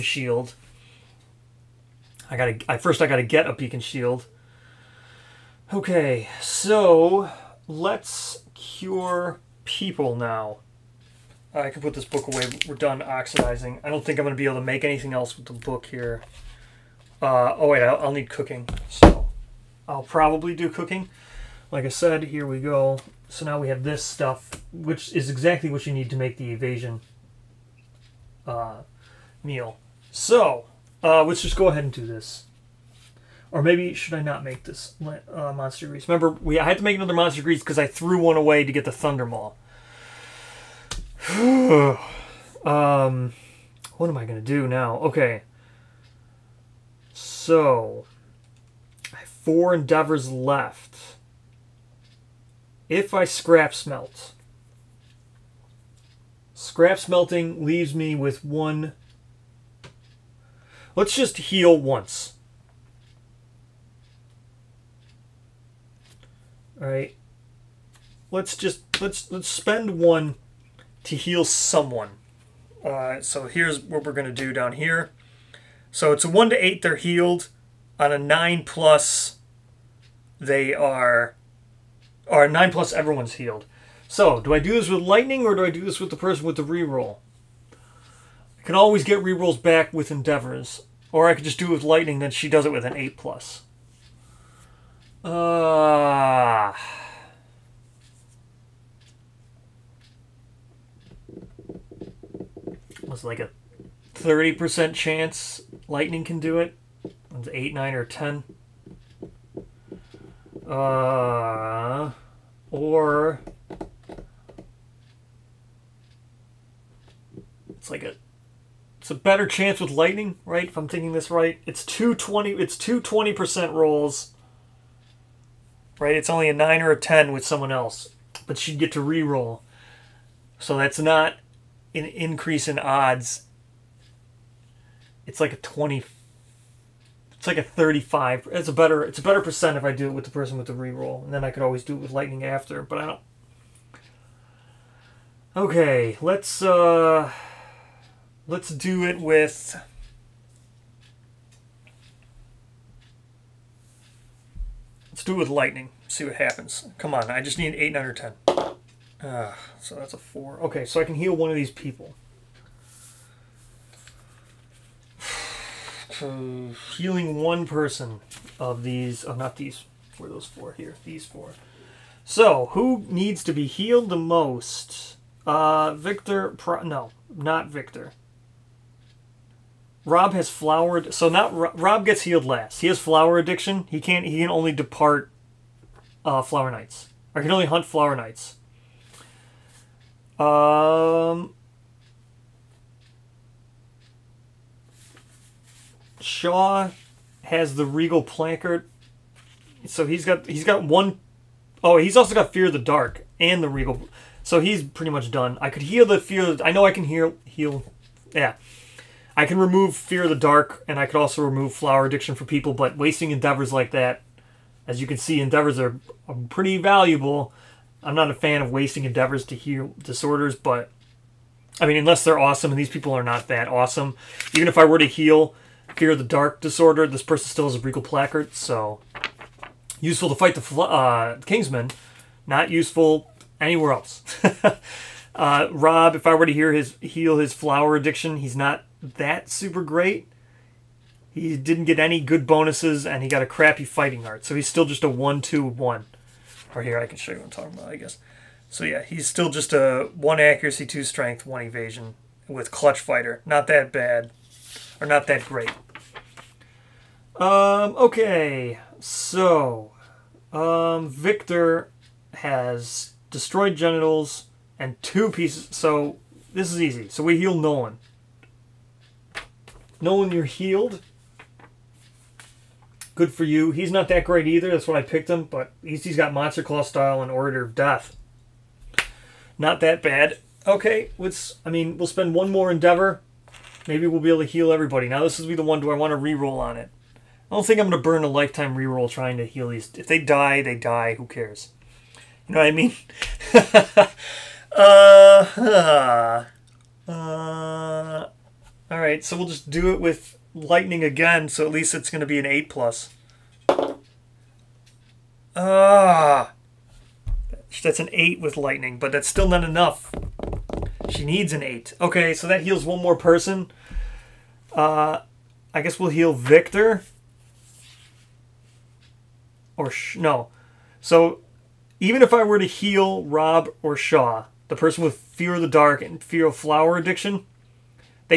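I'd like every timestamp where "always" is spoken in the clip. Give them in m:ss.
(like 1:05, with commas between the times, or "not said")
1:28, 2:21.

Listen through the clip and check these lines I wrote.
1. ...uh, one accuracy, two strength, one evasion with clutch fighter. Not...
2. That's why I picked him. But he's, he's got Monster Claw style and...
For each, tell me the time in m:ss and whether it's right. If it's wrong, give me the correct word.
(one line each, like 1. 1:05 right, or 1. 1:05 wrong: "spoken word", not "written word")
1. 4:10 right
2. 4:34 right.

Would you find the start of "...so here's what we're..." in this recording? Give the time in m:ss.
1:13.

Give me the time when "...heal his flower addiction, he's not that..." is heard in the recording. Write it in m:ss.
3:57.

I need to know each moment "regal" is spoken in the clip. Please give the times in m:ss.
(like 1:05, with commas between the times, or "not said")
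3:17, 3:23, 3:47.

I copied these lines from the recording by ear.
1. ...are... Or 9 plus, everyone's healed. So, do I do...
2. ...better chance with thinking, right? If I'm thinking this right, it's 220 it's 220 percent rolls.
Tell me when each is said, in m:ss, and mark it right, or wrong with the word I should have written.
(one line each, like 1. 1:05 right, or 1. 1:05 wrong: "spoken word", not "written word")
1. 1:20 right
2. 1:59 wrong: "lightning", not "thinking".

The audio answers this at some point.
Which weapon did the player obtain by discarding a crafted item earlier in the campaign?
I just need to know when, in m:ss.
0:38.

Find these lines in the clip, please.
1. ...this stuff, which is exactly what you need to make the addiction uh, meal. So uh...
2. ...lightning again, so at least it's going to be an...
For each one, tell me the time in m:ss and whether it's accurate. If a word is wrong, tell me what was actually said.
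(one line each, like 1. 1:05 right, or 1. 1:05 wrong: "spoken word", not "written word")
1. 0:23 wrong: "evasion", not "addiction"
2. 5:00 right.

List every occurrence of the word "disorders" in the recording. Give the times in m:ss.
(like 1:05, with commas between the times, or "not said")
3:40, 3:46.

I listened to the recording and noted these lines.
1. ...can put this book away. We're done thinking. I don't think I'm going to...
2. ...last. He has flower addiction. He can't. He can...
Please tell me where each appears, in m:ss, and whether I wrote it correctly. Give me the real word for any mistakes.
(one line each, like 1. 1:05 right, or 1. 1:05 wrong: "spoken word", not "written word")
1. 0:11 wrong: "oxidizing", not "thinking"
2. 3:02 right.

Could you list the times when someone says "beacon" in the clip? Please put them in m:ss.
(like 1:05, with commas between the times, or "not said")
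0:03.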